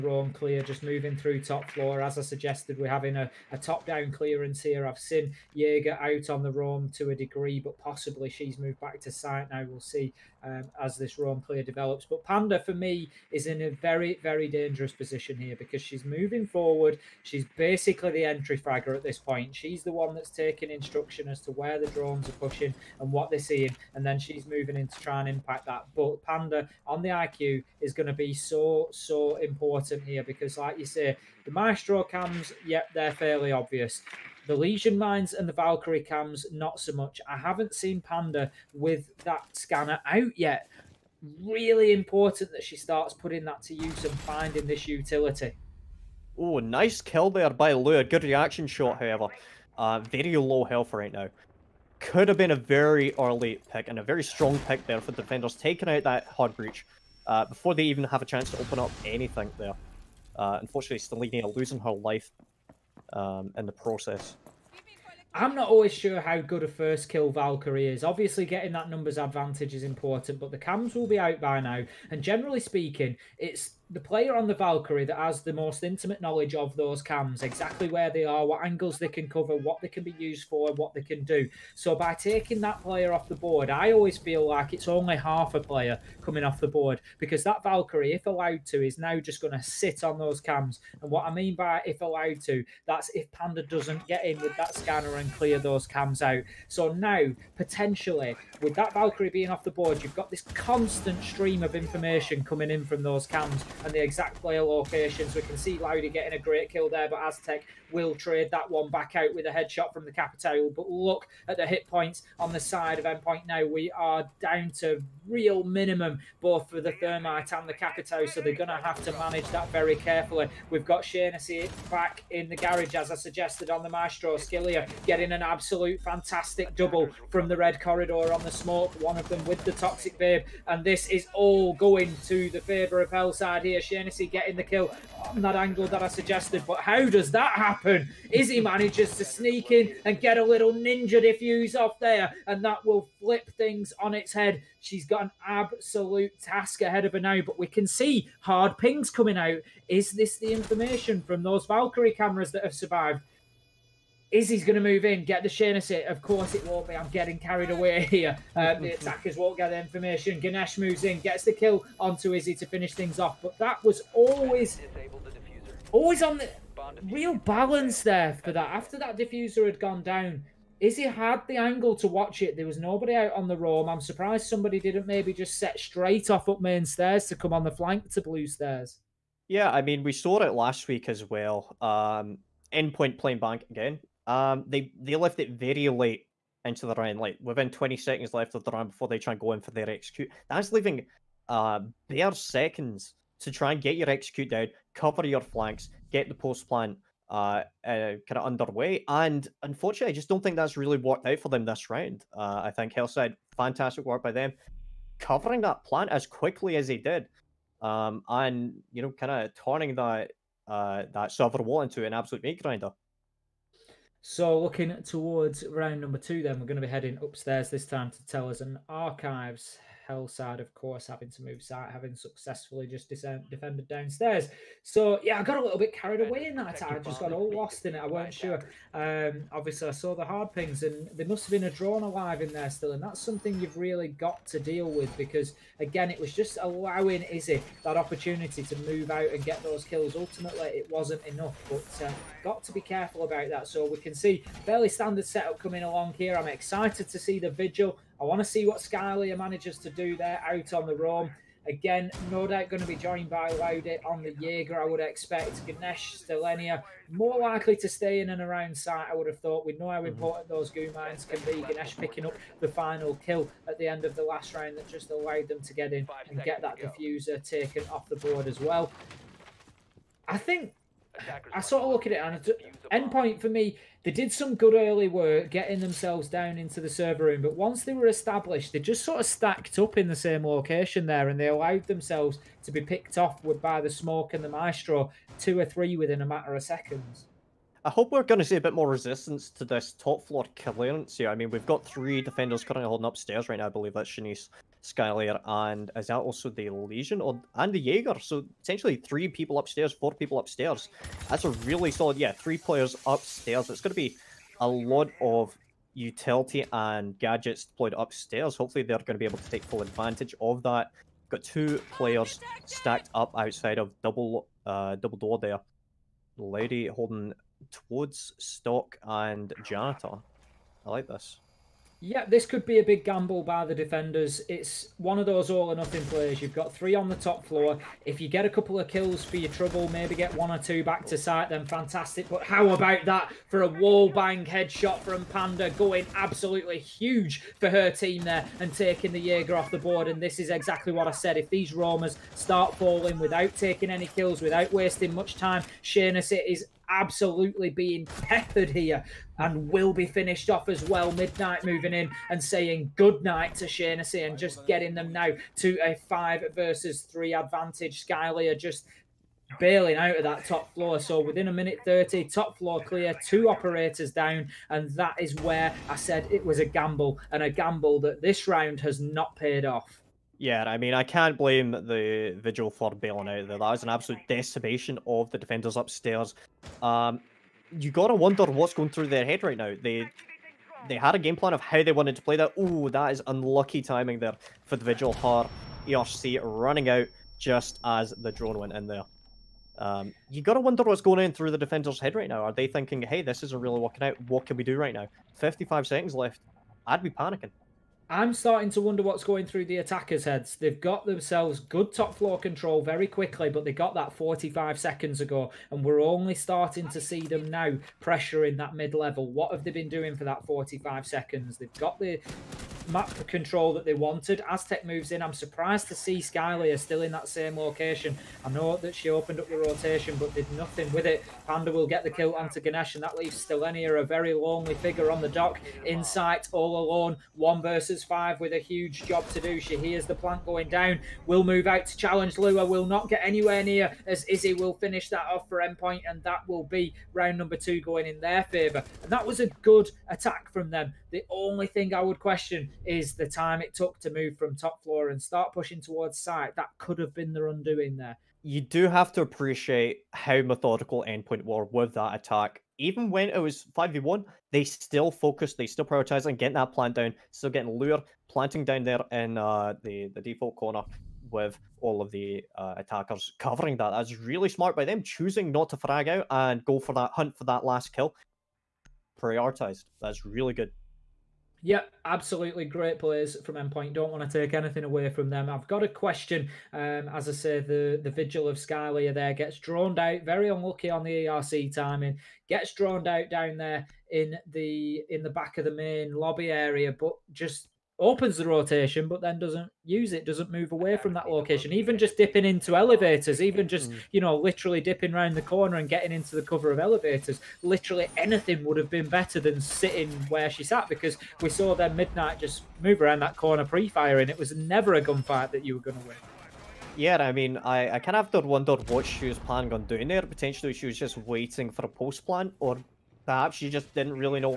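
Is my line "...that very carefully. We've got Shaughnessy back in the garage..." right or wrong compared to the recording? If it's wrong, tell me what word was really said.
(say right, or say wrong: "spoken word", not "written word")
right.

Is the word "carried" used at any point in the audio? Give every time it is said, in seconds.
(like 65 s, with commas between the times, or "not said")
157 s, 225 s.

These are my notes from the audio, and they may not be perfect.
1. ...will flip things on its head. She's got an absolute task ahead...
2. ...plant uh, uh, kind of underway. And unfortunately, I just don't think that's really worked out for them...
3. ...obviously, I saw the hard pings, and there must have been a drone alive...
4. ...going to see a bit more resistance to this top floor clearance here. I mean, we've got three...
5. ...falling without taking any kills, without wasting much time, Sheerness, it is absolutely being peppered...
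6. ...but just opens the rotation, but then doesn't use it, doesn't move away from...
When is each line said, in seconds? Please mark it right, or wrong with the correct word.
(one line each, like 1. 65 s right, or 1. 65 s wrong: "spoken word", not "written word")
1. 142 s right
2. 196 s right
3. 229 s right
4. 288 s right
5. 342 s right
6. 486 s right.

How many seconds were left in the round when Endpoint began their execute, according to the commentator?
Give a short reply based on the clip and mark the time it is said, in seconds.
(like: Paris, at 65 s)
20, at 187 s.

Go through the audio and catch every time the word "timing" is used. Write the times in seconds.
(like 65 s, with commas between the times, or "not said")
383 s, 481 s.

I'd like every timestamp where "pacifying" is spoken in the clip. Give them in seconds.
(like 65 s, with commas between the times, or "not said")
not said.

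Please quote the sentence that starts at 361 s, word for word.
So within a minute 30, top floor clear, two operators down.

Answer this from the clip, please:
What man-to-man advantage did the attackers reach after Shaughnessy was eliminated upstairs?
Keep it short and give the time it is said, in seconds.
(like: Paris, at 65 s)
five versus three, at 356 s.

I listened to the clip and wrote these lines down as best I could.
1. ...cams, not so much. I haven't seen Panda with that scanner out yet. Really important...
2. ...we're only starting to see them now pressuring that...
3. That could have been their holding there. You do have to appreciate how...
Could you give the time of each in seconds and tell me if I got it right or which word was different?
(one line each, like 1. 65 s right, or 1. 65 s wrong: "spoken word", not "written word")
1. 36 s right
2. 405 s right
3. 446 s wrong: "undoing", not "holding".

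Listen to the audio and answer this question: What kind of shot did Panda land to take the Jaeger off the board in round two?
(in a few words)
wall bang headshot.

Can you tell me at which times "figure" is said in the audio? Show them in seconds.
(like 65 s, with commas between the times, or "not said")
424 s.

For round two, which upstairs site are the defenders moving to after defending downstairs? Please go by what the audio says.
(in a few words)
archives.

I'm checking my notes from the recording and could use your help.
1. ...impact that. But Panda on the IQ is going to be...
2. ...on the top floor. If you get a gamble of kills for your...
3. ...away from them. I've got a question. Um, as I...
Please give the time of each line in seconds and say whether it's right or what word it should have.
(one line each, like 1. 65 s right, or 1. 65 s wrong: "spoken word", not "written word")
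1. 25 s right
2. 326 s wrong: "couple", not "gamble"
3. 474 s right.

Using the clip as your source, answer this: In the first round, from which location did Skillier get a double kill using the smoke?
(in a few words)
Red Corridor.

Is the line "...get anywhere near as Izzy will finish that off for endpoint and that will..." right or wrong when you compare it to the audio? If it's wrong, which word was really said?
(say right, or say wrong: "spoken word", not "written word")
right.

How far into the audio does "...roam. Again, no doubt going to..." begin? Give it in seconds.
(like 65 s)
250 s.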